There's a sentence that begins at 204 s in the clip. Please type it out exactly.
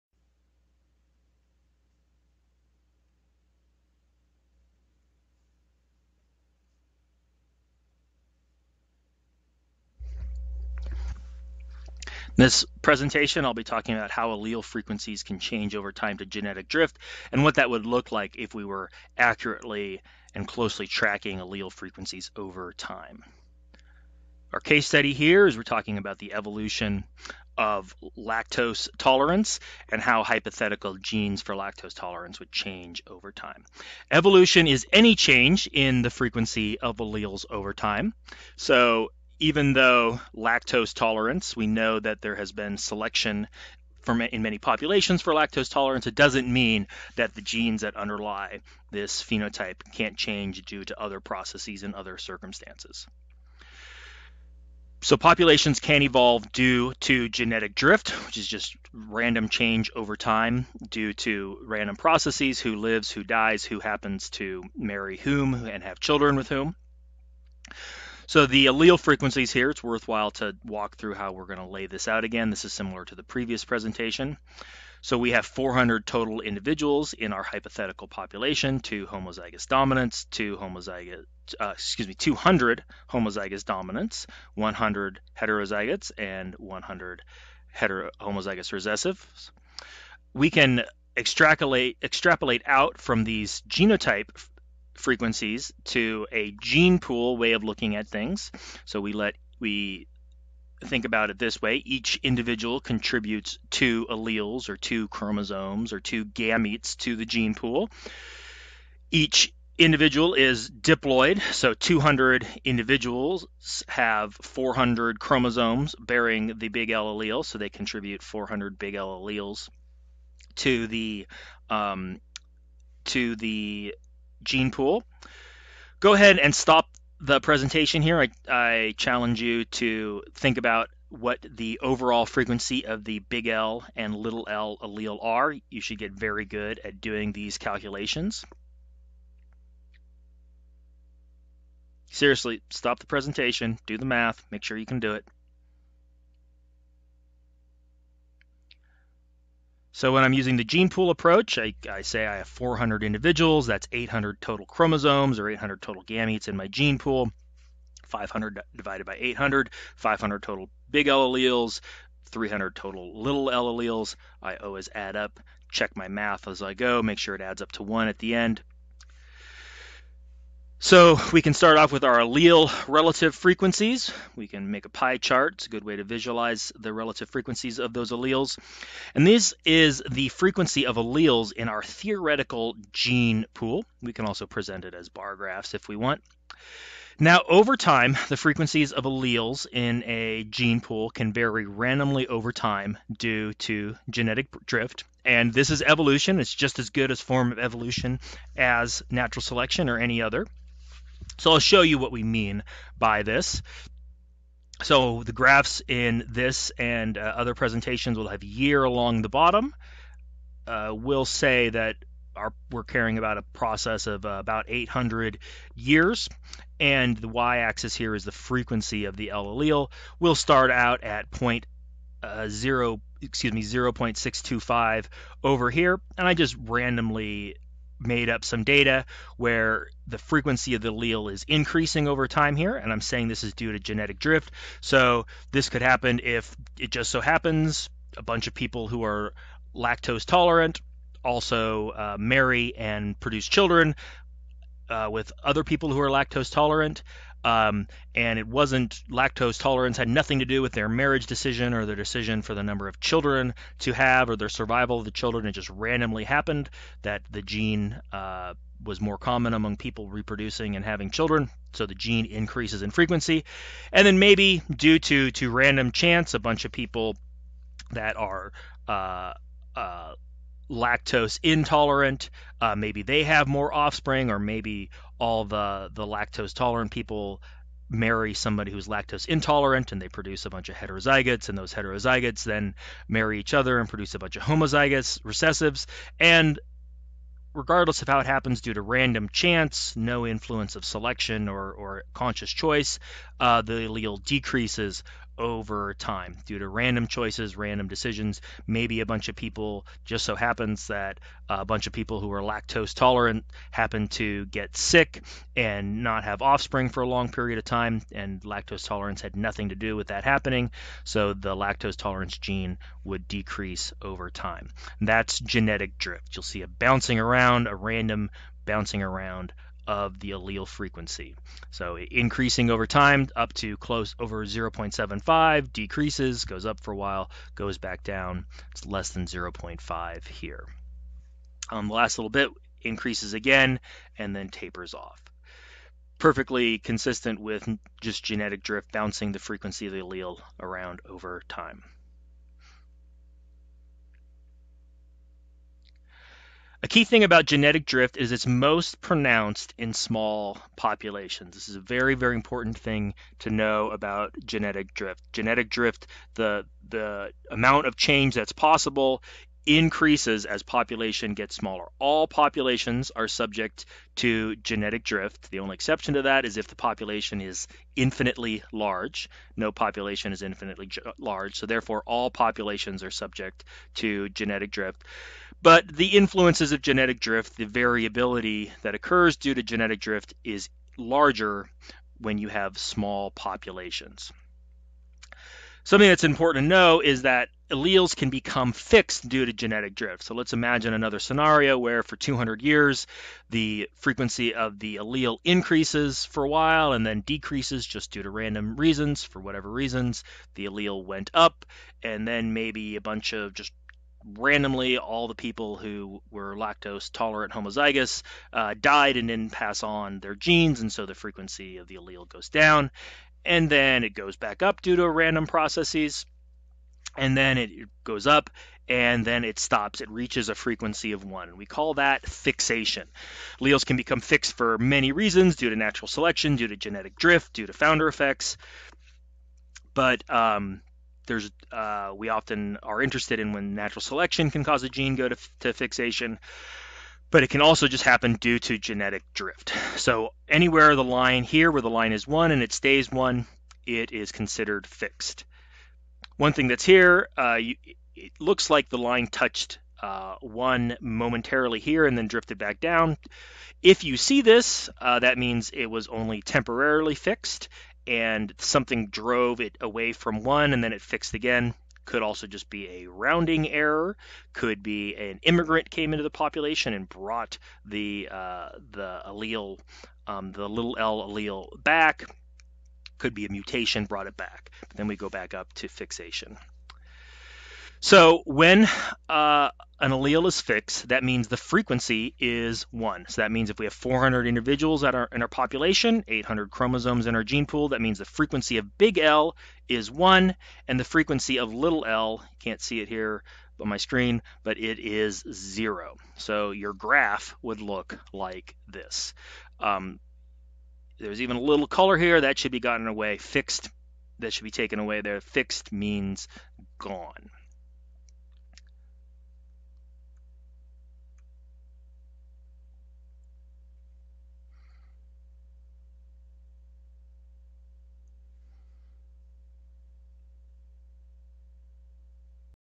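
So the graphs in this and uh, other presentations will have year along the bottom.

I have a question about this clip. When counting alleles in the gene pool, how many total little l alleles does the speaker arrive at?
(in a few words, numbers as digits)
300.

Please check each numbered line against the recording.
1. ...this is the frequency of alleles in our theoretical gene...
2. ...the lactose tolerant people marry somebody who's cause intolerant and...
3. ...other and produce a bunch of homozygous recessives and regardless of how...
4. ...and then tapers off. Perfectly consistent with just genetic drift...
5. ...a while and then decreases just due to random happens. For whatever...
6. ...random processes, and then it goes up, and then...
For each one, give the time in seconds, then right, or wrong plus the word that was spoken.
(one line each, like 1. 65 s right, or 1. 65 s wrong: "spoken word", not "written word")
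1. 179 s right
2. 275 s wrong: "lactose", not "cause"
3. 283 s right
4. 334 s right
5. 396 s wrong: "reasons", not "happens"
6. 415 s right.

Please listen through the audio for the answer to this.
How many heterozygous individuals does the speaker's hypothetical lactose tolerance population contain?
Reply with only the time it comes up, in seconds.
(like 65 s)
84 s.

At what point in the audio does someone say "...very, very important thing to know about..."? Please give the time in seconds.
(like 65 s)
351 s.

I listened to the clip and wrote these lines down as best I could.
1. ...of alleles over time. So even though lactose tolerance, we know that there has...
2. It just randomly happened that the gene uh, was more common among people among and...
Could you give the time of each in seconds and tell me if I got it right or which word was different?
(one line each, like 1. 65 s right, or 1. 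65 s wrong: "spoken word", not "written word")
1. 36 s right
2. 255 s wrong: "reproducing", not "among".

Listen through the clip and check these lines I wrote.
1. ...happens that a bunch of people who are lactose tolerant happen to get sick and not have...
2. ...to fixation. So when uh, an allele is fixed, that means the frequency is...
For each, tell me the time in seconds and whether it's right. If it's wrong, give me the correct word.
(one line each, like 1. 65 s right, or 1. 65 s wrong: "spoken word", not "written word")
1. 300 s right
2. 475 s right.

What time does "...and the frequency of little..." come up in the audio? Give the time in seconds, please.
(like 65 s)
490 s.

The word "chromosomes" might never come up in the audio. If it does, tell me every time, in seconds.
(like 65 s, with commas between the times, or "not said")
105 s, 115 s, 154 s, 486 s.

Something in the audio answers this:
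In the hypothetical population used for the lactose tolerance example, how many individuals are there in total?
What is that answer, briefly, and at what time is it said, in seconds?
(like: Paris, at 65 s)
400, at 75 s.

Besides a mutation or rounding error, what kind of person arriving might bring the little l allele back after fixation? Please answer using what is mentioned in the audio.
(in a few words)
an immigrant.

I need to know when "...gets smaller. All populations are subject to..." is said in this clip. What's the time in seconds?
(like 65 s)
361 s.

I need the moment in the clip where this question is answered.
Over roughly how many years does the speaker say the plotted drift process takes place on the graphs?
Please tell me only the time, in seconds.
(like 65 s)
214 s.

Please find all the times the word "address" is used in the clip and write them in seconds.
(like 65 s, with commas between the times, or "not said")
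not said.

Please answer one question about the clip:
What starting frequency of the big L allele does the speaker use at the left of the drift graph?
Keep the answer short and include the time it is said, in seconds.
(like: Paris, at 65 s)
0.625, at 223 s.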